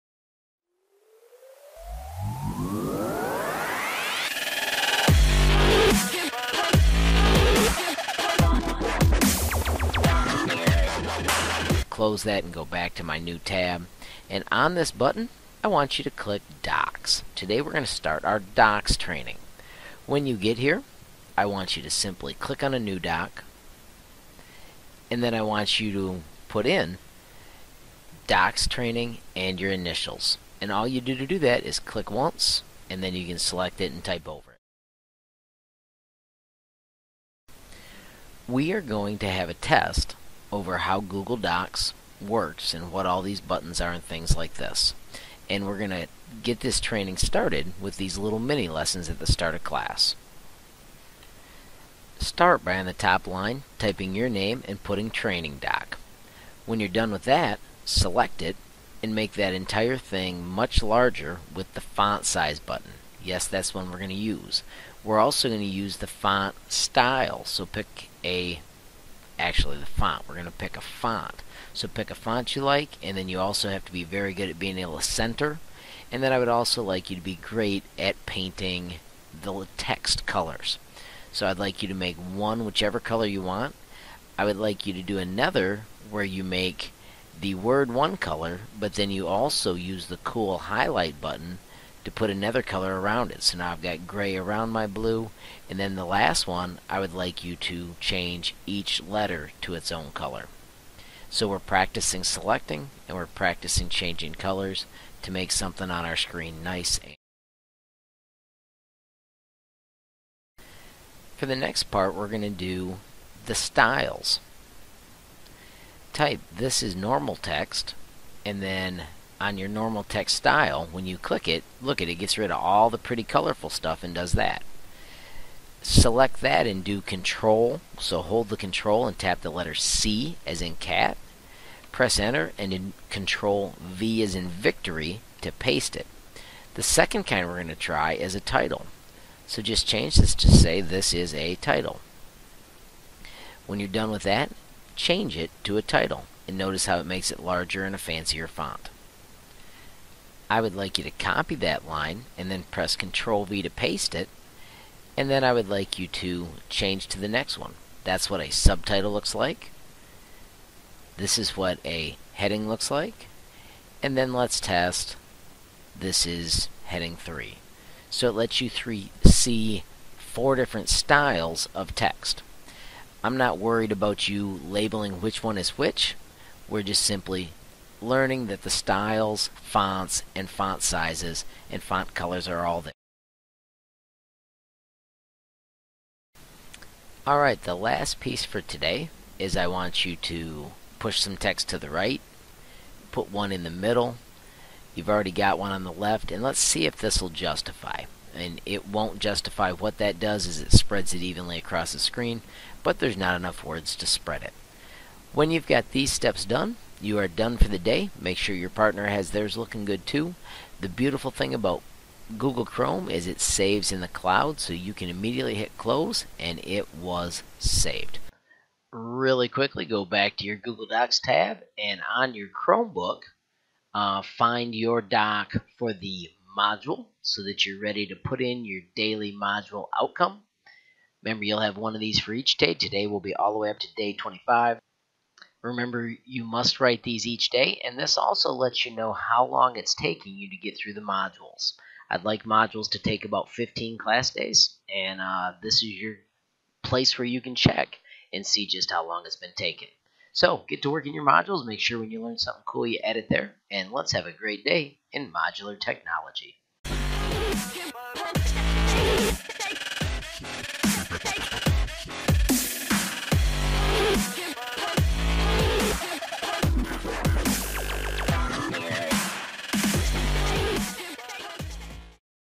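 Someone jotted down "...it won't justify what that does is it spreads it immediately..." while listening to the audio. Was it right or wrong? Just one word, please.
wrong.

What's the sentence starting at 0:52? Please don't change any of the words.
Start by on the top line typing your name and putting training doc.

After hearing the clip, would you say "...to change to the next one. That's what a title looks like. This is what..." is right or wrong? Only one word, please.
wrong.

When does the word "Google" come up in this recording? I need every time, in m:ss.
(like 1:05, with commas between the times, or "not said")
0:40, 3:32, 3:40.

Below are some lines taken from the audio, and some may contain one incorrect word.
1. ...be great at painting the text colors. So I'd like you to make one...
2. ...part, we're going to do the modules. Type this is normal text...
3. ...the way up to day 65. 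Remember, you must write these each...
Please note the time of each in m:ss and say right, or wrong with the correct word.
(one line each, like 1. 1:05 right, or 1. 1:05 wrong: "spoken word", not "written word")
1. 1:17 right
2. 1:51 wrong: "styles", not "modules"
3. 3:53 wrong: "25", not "65".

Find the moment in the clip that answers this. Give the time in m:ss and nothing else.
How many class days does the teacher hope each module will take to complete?
4:03.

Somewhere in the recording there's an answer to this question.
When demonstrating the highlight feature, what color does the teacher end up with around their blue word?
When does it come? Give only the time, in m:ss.
1:34.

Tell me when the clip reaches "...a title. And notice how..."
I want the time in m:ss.
2:25.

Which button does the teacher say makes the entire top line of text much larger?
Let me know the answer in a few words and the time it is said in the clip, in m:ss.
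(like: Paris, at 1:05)
font size button, at 1:01.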